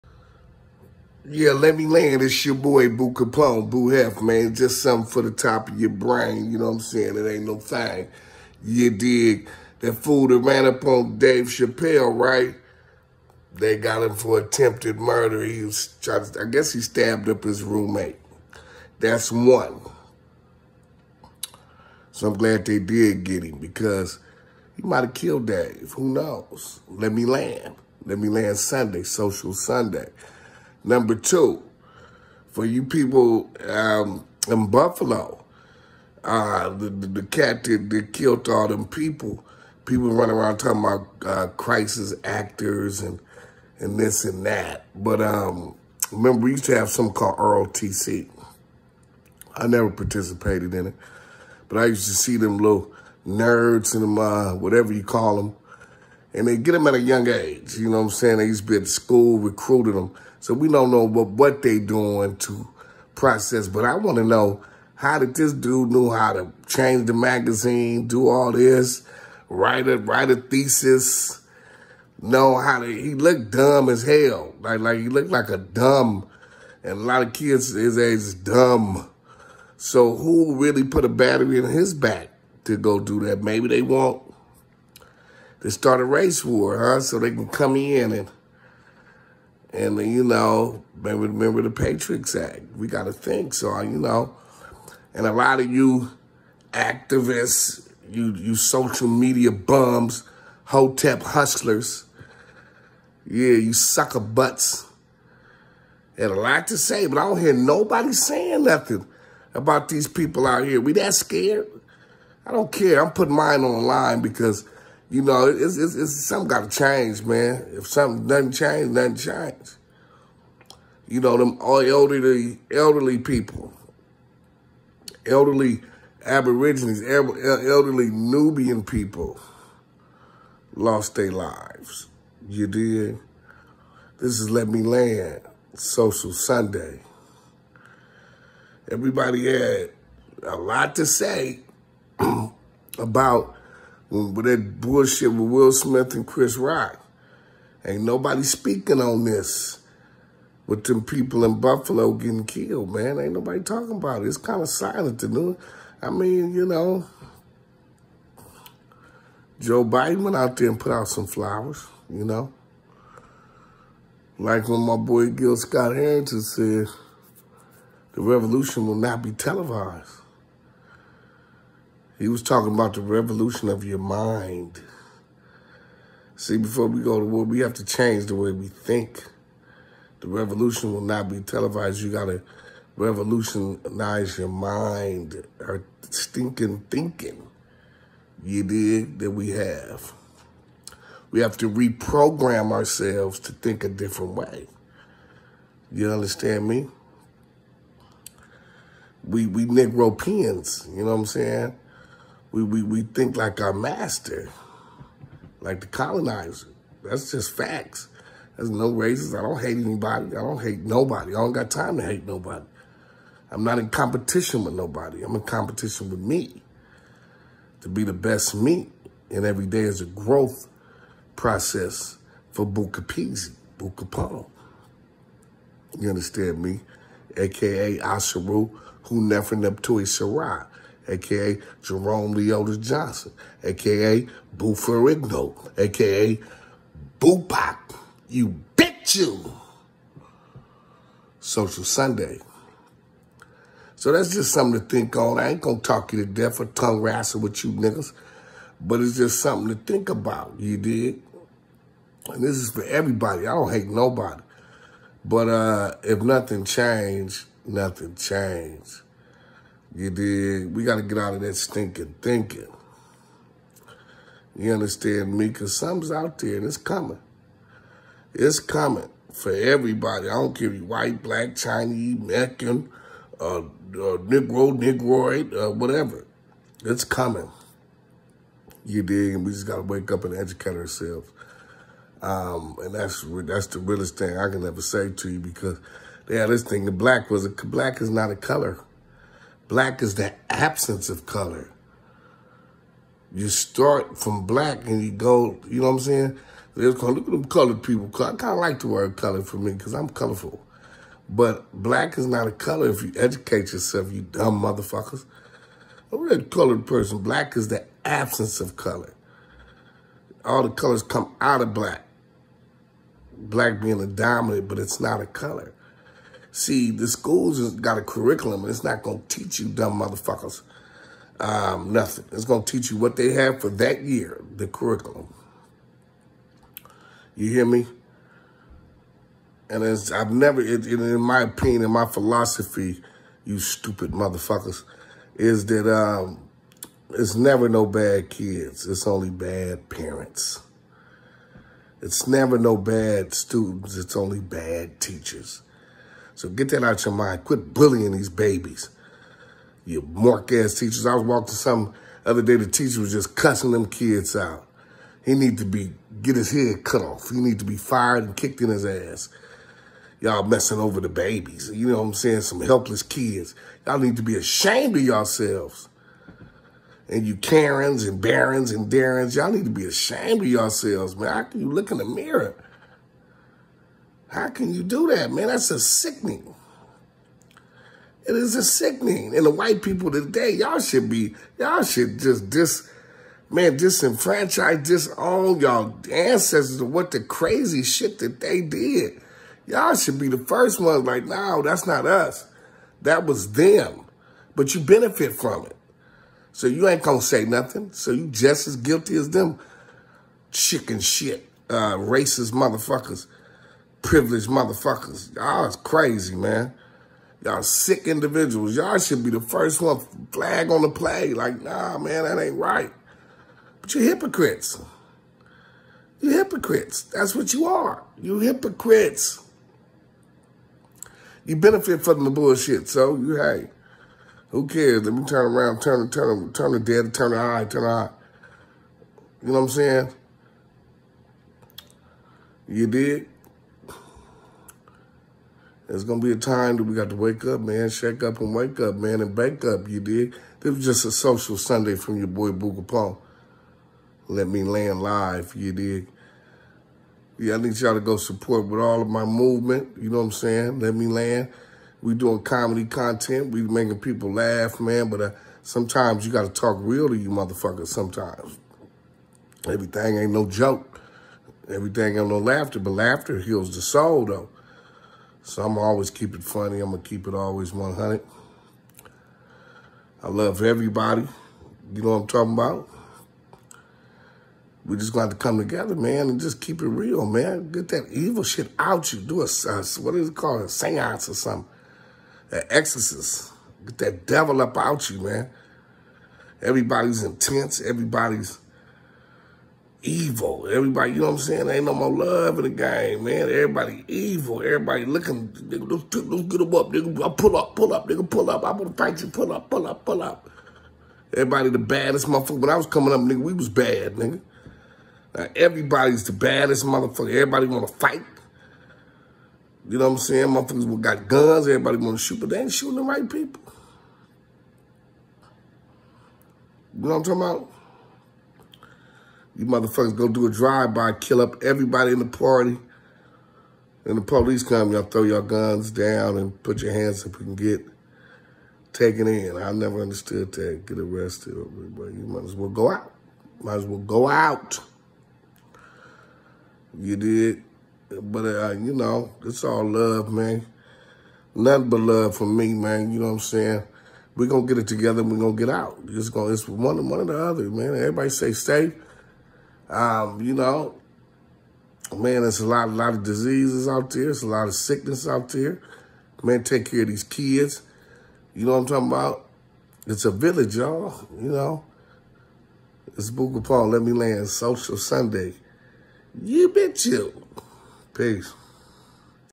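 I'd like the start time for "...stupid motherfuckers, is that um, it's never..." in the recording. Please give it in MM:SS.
05:33.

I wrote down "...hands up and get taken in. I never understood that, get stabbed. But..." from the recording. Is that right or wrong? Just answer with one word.
wrong.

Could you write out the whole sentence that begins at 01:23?
Maybe they want to start a race war, huh?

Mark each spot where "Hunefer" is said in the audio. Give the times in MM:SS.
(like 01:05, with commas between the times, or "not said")
03:49.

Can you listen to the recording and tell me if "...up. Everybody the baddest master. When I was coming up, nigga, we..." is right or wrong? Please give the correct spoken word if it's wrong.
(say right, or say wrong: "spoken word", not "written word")
wrong: "motherfucker", not "master".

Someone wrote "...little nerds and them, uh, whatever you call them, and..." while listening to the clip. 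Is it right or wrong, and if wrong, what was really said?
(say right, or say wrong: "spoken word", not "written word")
right.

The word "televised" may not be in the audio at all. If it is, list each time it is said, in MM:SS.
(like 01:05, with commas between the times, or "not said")
02:49, 03:01.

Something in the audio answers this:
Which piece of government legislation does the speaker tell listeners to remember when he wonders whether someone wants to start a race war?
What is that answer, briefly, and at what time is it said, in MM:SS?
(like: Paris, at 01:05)
Patriots Act, at 01:31.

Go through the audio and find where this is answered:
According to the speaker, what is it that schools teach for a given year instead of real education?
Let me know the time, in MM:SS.
05:24.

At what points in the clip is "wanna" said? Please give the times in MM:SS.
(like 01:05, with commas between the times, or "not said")
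08:27, 08:31.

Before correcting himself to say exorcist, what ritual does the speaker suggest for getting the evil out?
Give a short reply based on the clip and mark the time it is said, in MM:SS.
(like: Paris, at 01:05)
a seance, at 08:00.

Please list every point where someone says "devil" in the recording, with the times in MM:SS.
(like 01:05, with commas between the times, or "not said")
08:04.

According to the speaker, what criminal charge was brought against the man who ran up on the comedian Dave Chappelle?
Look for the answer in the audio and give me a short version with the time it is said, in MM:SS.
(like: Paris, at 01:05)
attempted murder, at 00:14.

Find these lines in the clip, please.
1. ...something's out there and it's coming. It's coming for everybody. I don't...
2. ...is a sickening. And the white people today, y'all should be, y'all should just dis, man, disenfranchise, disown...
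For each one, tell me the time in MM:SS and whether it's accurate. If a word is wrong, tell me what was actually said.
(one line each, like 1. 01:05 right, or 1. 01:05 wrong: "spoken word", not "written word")
1. 04:25 right
2. 06:18 right.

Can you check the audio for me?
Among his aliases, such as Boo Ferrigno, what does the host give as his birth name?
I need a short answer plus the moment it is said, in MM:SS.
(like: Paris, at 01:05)
Jerome Leota Johnson, at 03:51.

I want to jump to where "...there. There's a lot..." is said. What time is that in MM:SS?
09:14.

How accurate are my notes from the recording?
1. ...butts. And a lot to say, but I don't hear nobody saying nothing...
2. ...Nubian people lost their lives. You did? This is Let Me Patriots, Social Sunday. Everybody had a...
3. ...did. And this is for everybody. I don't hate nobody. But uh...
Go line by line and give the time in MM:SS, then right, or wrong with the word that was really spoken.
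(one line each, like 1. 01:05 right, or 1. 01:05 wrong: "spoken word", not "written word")
1. 01:44 right
2. 02:08 wrong: "Land", not "Patriots"
3. 04:10 right.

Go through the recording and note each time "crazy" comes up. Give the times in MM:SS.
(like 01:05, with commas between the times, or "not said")
06:27, 06:45.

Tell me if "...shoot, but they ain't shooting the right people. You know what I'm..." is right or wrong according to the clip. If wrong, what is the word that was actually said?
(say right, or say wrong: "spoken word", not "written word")
right.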